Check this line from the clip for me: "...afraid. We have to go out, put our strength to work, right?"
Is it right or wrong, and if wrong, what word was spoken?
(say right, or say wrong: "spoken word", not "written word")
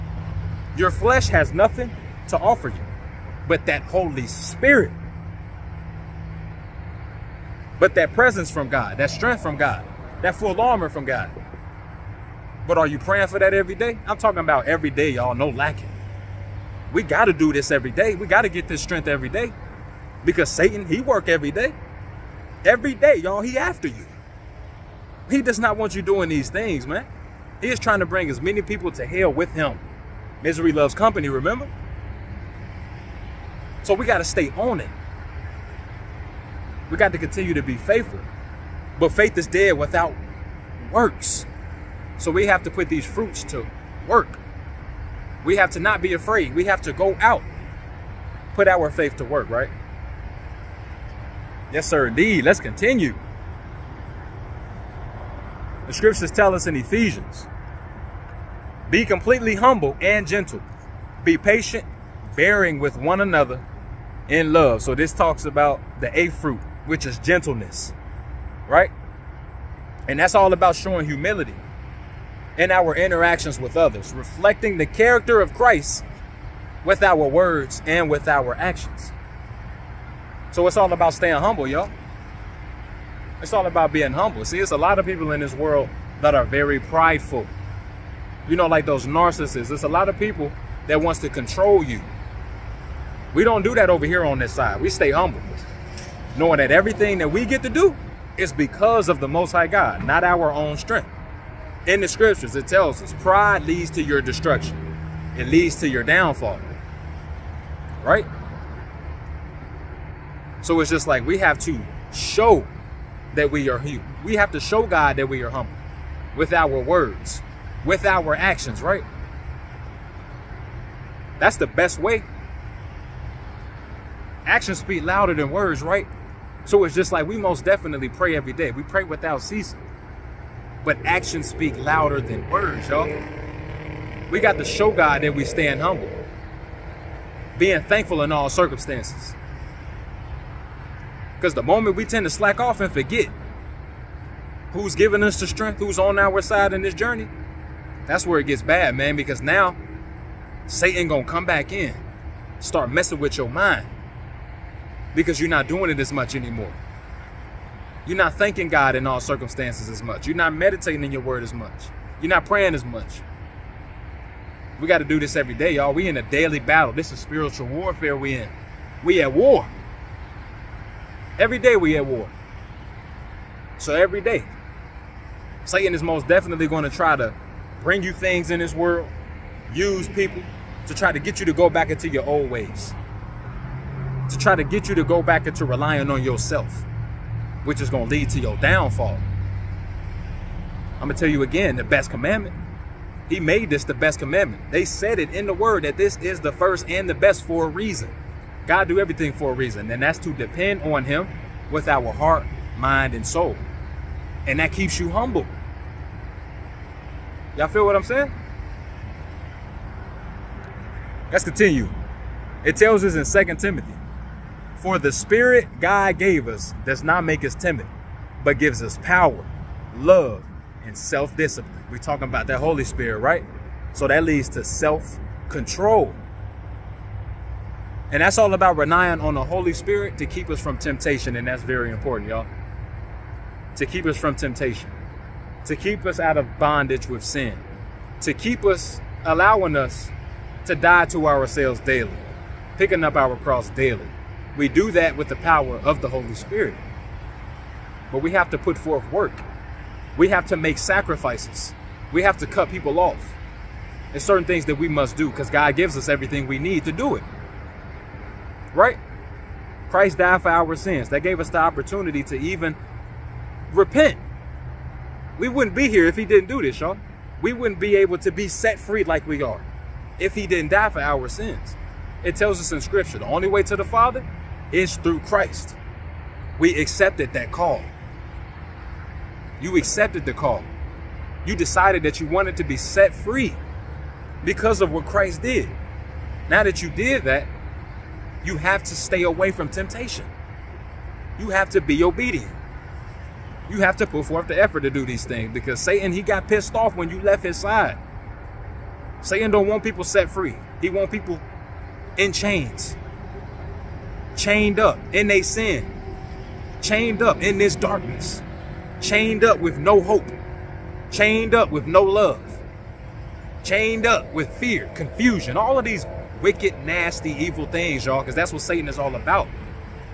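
wrong: "faith", not "strength".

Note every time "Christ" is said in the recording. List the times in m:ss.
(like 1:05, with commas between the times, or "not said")
1:15, 4:19, 4:35, 4:45.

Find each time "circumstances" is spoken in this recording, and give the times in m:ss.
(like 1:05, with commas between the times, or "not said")
2:18, 2:39.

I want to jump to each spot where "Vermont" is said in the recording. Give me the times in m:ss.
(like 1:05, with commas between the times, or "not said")
not said.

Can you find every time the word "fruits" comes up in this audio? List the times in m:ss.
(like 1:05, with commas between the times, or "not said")
0:43, 1:06.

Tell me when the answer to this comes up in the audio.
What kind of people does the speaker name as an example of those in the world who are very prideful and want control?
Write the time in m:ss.
1:29.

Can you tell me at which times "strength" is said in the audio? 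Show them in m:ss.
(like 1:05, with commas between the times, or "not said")
0:09, 0:18, 1:40, 2:25.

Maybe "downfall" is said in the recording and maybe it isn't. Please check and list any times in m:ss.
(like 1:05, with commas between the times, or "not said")
1:46, 3:08.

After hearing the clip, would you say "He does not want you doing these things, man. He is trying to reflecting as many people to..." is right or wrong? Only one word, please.
wrong.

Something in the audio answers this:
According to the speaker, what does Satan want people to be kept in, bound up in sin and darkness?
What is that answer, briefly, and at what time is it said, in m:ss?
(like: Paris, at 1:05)
Chains, at 5:02.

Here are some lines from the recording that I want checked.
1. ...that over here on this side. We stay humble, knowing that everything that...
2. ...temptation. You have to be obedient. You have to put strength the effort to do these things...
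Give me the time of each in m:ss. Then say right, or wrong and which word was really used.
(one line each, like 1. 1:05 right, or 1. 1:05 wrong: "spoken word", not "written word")
1. 1:33 right
2. 4:49 wrong: "forth", not "strength".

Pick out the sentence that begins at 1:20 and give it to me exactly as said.
So it's all about staying humble, y'all.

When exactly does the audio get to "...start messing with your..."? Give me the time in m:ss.
2:32.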